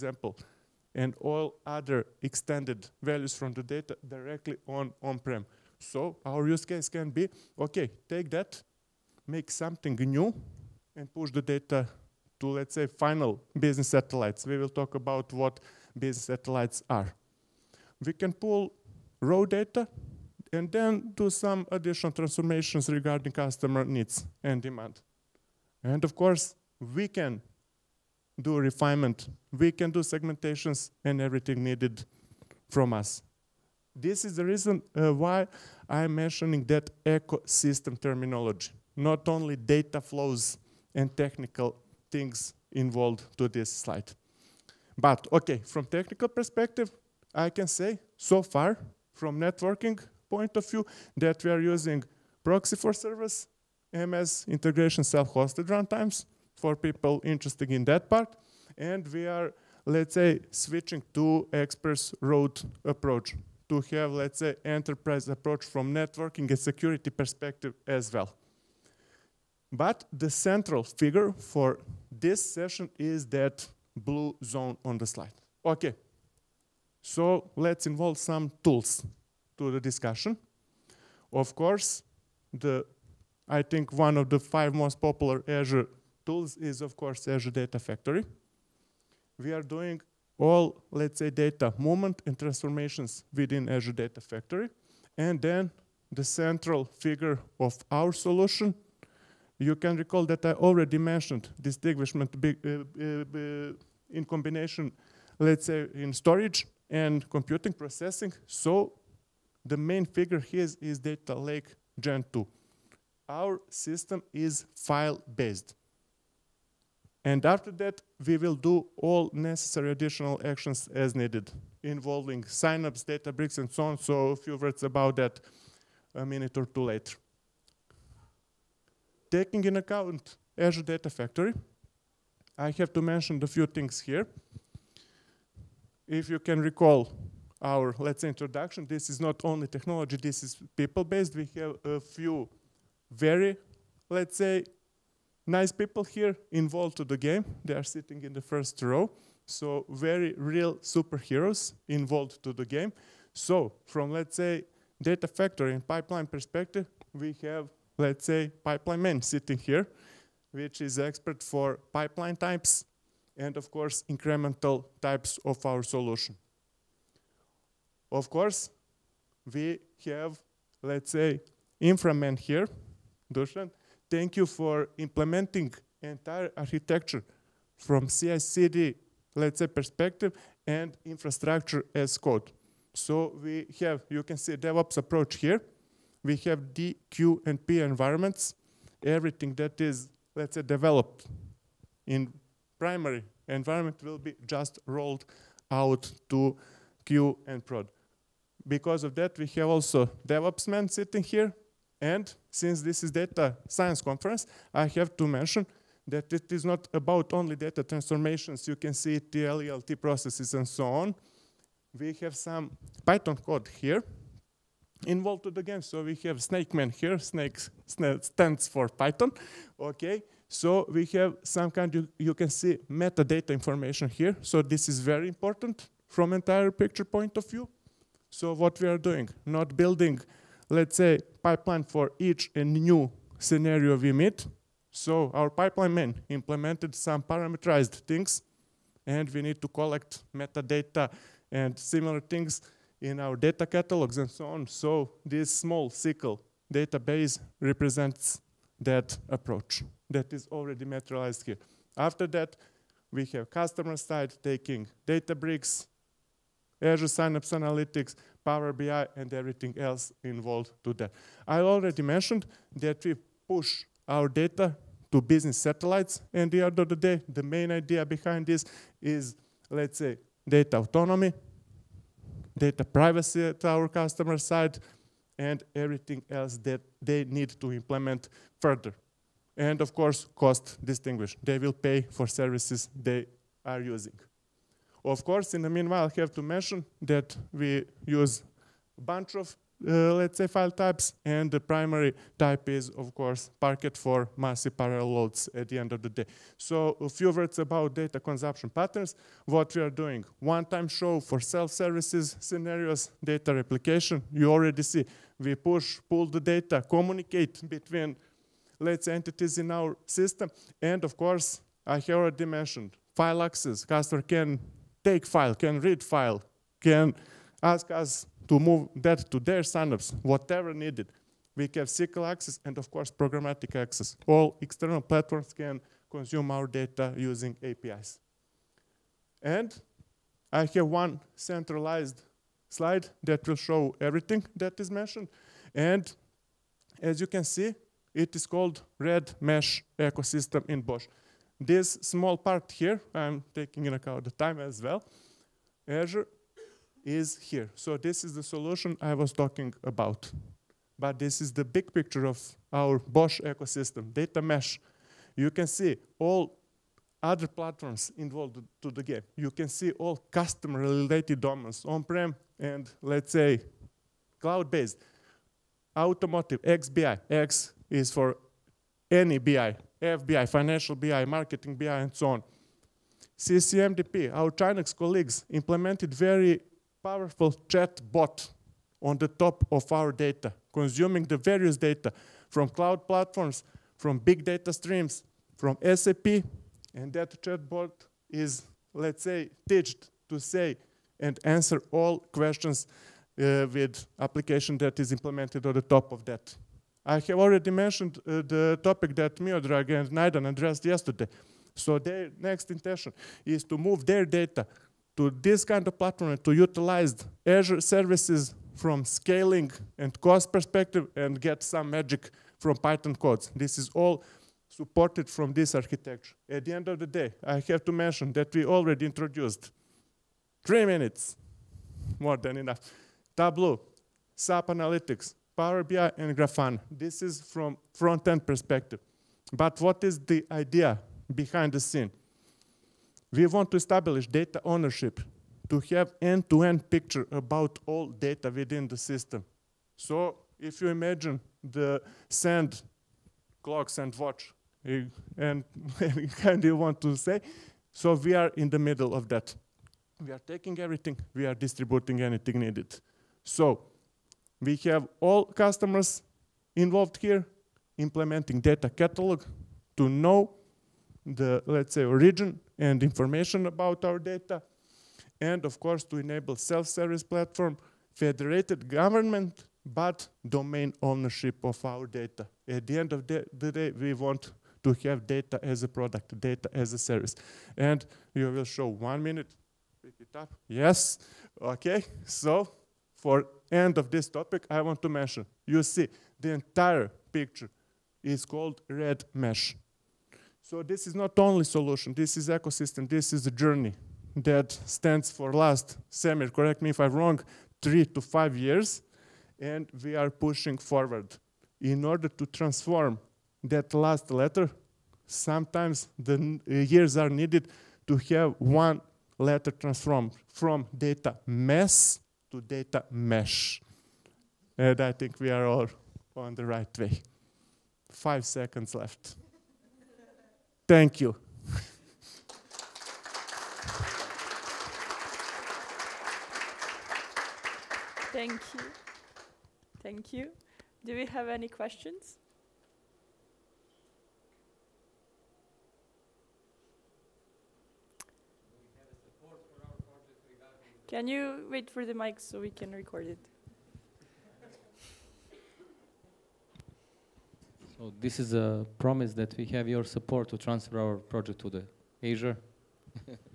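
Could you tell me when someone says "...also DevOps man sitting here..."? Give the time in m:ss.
3:19.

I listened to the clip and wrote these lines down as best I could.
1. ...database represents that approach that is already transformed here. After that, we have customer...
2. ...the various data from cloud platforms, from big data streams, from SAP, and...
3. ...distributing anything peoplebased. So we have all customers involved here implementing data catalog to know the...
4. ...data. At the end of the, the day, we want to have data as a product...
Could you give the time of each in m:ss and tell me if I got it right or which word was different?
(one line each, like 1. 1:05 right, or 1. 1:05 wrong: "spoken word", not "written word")
1. 4:06 wrong: "materialized", not "transformed"
2. 6:21 right
3. 7:31 wrong: "needed", not "peoplebased"
4. 7:52 right.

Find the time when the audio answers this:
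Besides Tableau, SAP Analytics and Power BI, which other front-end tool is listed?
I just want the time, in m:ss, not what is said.
7:06.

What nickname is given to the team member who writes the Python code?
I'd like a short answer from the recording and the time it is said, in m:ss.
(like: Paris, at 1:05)
snakeman, at 3:36.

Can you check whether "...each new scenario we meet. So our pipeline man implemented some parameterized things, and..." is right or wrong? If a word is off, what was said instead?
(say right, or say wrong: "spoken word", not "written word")
right.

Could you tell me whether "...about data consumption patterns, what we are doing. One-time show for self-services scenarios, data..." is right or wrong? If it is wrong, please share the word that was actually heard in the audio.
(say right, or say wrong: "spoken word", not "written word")
right.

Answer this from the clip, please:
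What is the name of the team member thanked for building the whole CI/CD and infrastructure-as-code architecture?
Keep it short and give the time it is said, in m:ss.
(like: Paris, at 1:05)
Dusan, at 2:53.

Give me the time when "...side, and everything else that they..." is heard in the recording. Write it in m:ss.
4:34.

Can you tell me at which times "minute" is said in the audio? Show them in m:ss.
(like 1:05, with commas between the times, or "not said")
2:06, 7:00, 7:59.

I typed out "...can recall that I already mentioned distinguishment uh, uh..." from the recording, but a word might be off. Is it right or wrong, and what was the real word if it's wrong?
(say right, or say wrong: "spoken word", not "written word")
right.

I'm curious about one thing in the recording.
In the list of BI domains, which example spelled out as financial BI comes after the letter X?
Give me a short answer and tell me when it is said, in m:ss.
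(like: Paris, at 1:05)
FBI, at 6:10.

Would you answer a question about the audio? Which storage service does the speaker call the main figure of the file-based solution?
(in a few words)
Data Lake Gen 2.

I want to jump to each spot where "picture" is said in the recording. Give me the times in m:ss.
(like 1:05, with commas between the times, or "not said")
3:46, 5:51, 7:16, 8:07.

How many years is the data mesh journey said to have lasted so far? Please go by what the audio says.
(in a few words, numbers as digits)
3 to 5 years.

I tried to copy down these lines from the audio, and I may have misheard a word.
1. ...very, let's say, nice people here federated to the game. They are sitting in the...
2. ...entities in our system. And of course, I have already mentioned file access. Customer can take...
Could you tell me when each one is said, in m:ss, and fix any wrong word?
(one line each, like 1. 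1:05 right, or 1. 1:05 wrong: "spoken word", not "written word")
1. 2:23 wrong: "involved", not "federated"
2. 5:09 right.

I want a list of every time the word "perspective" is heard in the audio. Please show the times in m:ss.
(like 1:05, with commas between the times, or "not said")
0:46, 1:07, 2:36, 2:59, 6:50, 7:08.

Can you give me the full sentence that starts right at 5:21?
We have SQL access and, of course, programmatic access.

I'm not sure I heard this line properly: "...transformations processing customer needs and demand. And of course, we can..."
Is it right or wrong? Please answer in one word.
wrong.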